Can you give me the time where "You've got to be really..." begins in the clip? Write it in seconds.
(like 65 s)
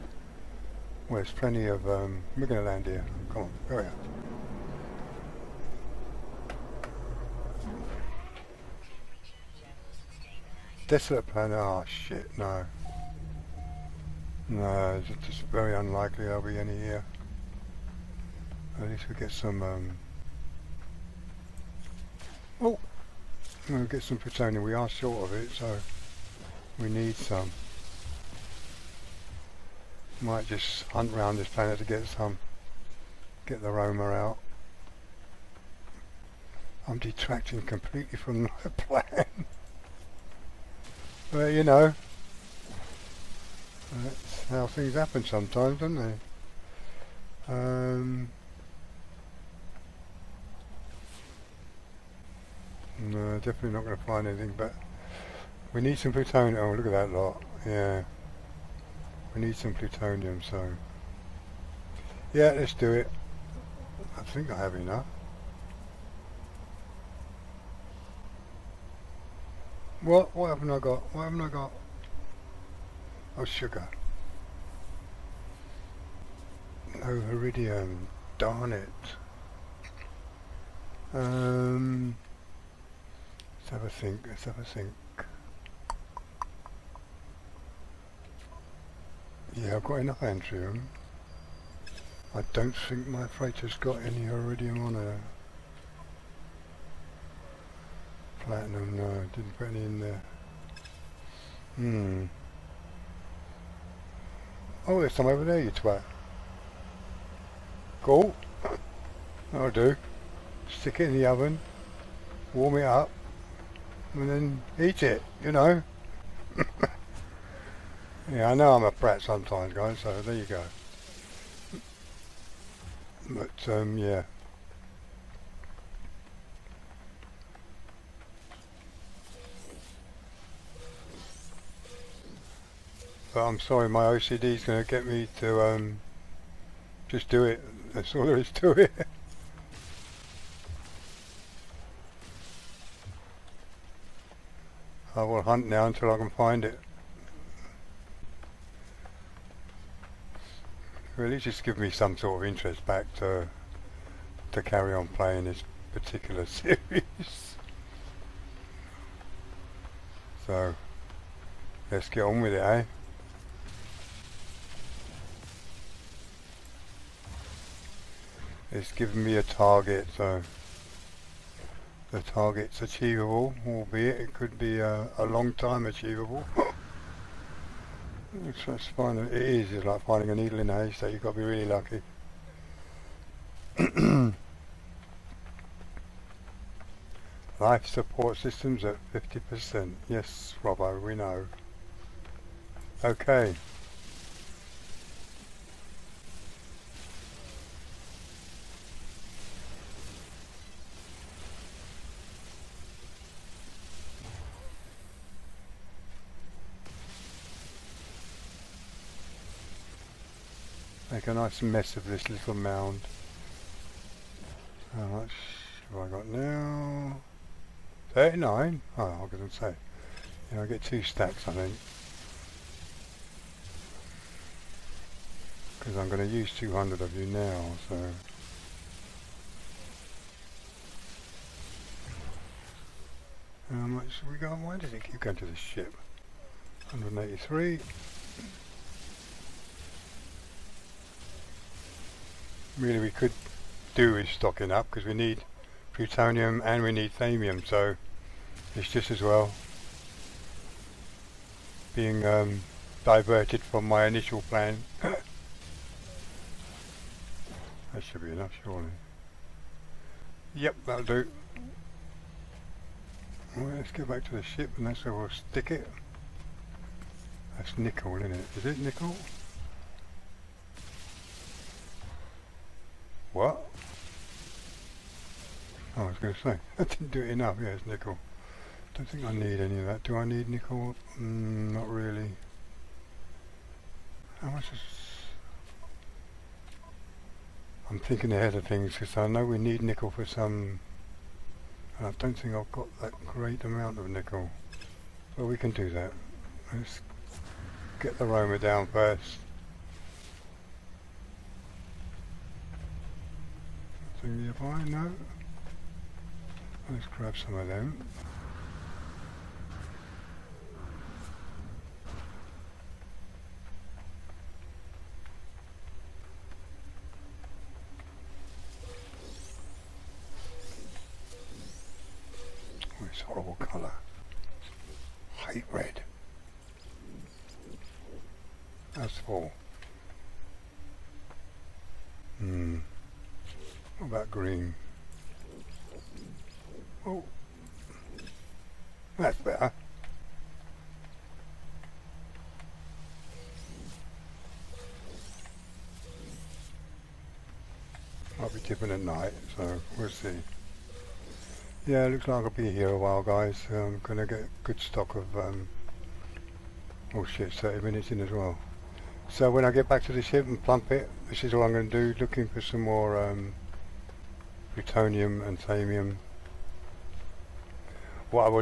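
181 s.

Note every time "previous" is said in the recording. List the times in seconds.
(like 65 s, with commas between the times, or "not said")
not said.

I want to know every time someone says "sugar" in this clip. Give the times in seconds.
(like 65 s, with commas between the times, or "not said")
73 s.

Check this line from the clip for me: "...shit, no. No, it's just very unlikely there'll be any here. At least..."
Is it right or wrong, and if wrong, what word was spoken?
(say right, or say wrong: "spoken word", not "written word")
right.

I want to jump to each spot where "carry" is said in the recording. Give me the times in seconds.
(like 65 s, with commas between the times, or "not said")
154 s.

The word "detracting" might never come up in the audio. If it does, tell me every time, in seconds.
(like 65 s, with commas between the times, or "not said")
36 s.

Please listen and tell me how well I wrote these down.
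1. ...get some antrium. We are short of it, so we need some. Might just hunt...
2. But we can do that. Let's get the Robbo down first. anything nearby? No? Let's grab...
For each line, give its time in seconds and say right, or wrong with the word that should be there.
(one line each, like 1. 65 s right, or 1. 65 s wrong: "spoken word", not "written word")
1. 23 s wrong: "plutonium", not "antrium"
2. 295 s wrong: "Roamer", not "Robbo".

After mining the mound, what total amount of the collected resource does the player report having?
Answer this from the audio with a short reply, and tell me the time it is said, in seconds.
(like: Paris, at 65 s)
183, at 236 s.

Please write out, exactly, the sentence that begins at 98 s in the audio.
Platinum, no, didn't put any in there.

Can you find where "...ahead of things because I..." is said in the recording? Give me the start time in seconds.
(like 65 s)
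288 s.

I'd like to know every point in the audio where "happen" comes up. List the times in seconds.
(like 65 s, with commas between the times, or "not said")
44 s.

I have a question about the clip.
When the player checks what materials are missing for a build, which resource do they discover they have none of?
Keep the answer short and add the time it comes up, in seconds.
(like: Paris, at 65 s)
viridium, at 77 s.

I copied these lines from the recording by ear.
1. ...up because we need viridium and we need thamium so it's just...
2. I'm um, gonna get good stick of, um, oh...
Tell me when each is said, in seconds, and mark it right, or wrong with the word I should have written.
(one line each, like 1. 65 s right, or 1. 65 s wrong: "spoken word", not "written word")
1. 244 s wrong: "plutonium", not "viridium"
2. 353 s wrong: "stock", not "stick".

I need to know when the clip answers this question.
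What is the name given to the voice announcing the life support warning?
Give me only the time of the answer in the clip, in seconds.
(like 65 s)
190 s.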